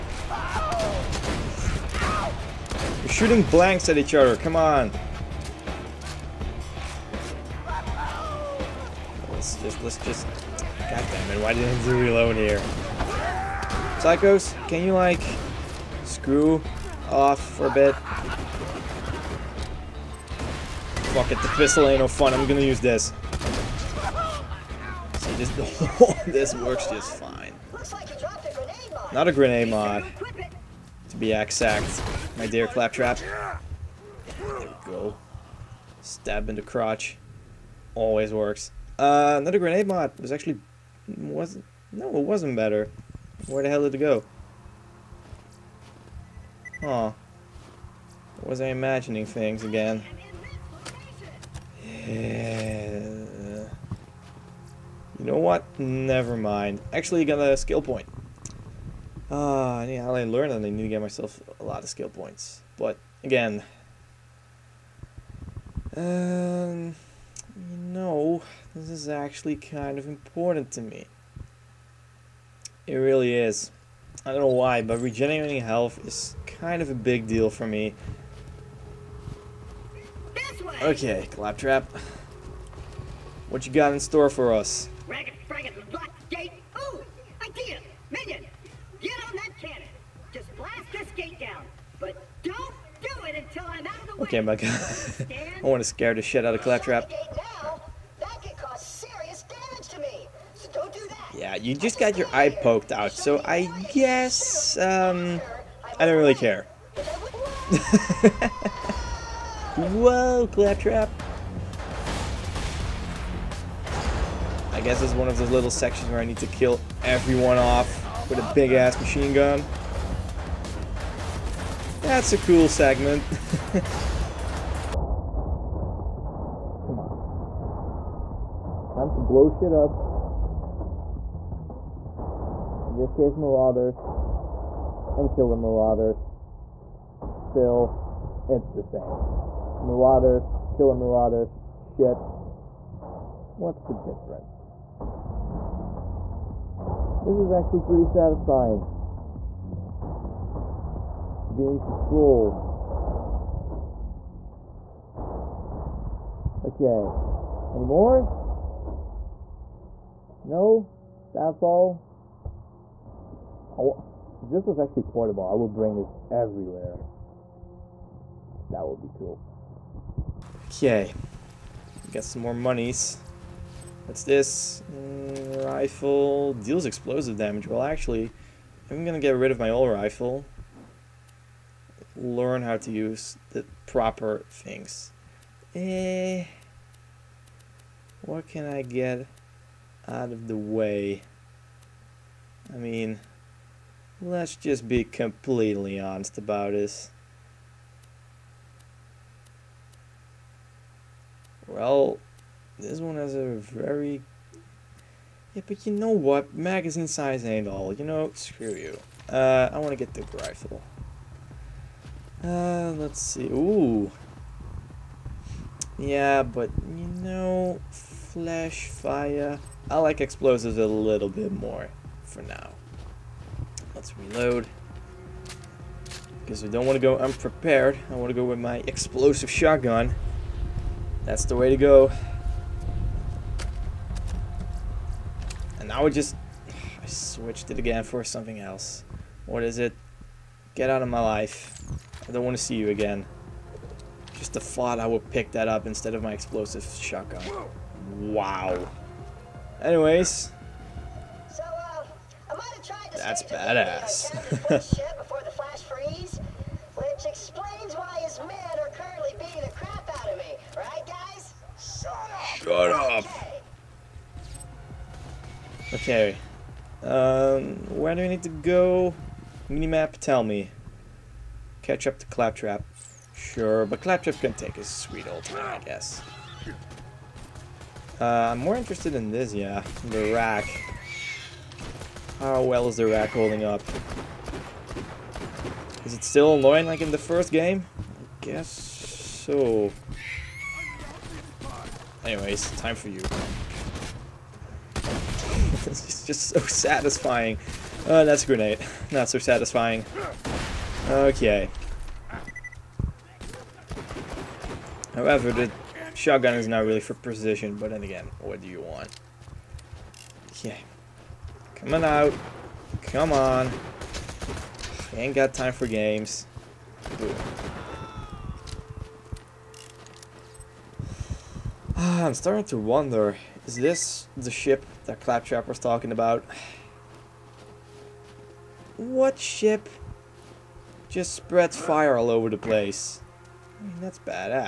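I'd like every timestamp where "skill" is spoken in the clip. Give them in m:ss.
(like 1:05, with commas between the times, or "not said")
0:57, 1:01.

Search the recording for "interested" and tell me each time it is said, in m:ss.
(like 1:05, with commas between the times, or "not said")
4:38.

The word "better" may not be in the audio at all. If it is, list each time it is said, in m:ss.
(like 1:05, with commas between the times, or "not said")
0:42.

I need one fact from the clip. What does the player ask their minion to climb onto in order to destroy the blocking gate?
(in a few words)
cannon.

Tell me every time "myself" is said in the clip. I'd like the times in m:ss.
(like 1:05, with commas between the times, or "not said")
1:01.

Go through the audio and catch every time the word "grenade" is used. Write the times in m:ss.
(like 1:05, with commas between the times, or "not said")
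0:29, 0:39, 4:58.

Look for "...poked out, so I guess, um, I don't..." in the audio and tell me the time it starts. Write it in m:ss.
1:42.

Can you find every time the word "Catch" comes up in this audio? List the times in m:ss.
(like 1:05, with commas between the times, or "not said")
4:31.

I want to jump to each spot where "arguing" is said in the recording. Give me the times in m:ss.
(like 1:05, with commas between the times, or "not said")
not said.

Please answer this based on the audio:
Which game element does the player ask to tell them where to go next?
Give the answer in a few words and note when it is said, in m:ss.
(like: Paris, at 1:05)
Minimap, at 4:29.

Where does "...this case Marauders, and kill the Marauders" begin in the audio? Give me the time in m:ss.
2:12.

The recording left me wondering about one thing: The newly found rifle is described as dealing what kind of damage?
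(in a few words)
explosive damage.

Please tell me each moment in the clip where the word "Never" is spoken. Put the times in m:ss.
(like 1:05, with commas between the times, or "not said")
0:55.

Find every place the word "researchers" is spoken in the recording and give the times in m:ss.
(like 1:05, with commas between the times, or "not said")
not said.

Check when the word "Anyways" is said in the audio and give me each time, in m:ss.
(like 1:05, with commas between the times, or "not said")
4:09, 4:52.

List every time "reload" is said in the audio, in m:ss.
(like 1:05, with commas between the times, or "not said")
0:11, 3:44.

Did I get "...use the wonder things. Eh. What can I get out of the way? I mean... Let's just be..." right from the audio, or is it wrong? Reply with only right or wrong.
wrong.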